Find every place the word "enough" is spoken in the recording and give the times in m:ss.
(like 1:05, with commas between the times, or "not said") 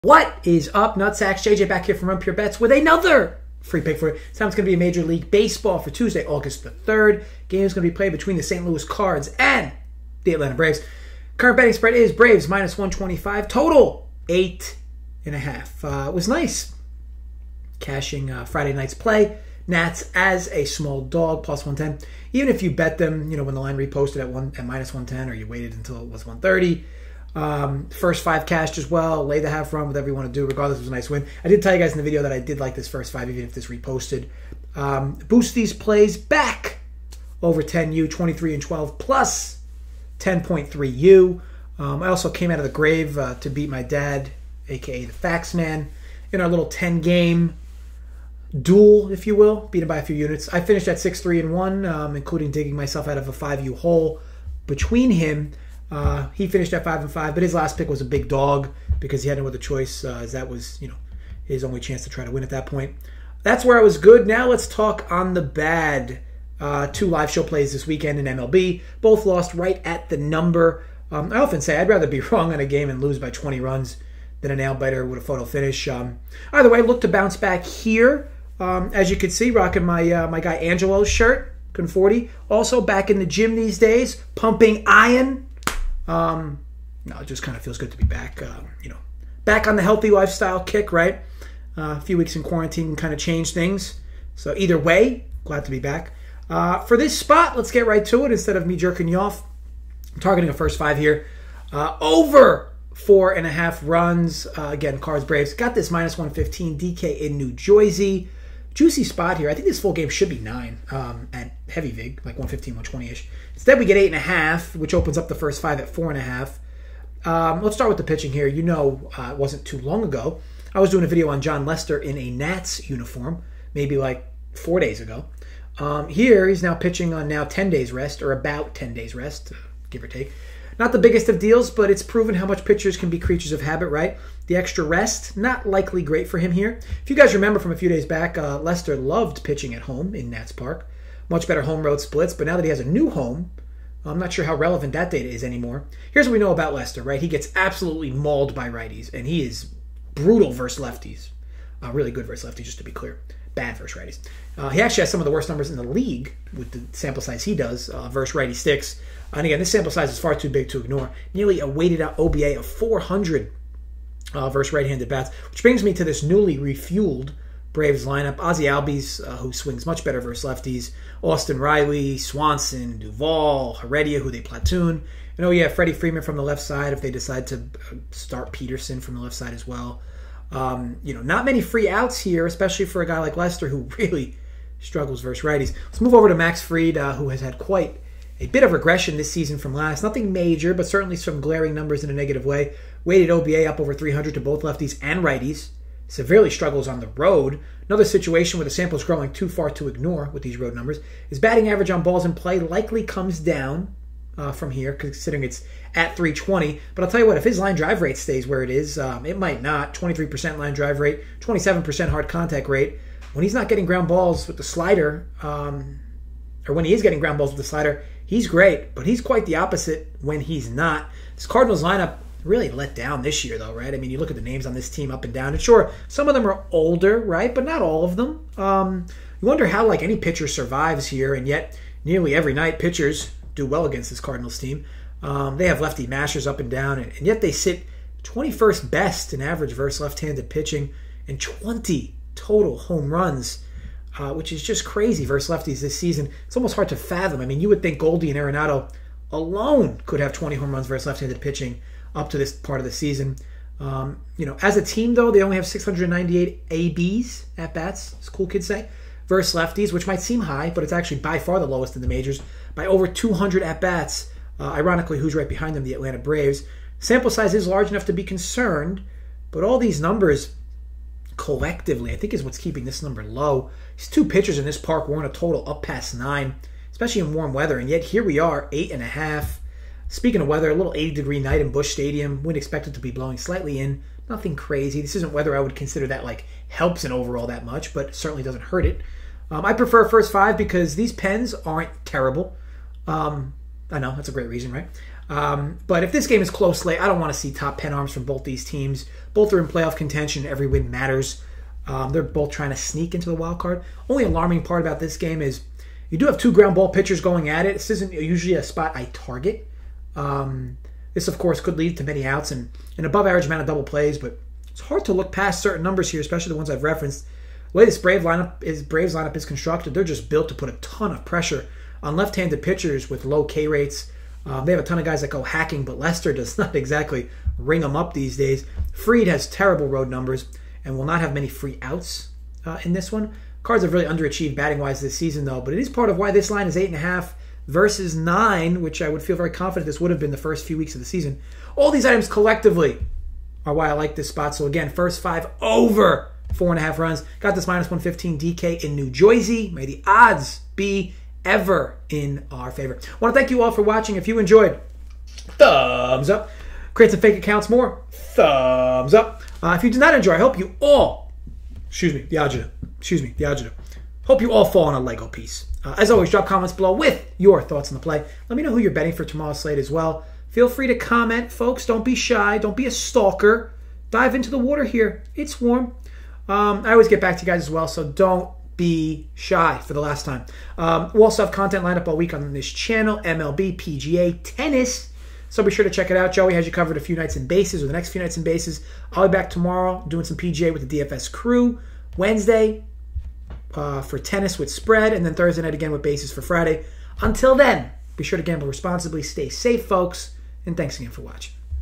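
4:27.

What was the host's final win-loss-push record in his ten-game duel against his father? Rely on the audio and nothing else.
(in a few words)
6-3-1.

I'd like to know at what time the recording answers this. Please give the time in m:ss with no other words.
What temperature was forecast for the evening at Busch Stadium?
4:40.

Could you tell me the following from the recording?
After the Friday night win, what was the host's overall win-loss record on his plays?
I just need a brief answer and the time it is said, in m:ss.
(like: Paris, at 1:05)
23 and 12, at 0:38.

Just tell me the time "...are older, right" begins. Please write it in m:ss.
3:46.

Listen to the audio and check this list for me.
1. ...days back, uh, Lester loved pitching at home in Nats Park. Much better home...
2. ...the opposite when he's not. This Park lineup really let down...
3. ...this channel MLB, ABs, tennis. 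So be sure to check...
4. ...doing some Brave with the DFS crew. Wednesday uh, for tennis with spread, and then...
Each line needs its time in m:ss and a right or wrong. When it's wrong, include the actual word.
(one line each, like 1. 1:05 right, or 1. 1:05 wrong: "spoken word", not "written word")
1. 2:17 right
2. 3:39 wrong: "Cardinals", not "Park"
3. 6:22 wrong: "PGA", not "ABs"
4. 6:30 wrong: "PGA", not "Brave".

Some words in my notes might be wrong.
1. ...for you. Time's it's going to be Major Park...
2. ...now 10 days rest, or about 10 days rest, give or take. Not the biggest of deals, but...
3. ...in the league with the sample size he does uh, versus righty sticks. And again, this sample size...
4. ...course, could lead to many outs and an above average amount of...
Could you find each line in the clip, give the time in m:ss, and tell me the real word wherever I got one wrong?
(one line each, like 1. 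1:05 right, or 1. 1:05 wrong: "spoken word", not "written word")
1. 0:03 wrong: "League", not "Park"
2. 2:07 right
3. 2:35 right
4. 5:11 right.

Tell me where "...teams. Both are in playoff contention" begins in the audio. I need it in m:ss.
4:58.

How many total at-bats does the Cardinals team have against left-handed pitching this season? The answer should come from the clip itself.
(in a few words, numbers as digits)
698.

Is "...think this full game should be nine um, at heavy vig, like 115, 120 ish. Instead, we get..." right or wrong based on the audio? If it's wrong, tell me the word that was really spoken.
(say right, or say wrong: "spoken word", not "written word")
right.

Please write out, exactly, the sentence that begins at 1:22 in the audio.
Also back in the gym these days, pumping iron.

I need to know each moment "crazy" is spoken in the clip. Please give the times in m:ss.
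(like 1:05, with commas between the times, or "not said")
4:04, 4:44.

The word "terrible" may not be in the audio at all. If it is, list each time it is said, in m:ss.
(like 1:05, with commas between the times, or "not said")
4:52, 5:29.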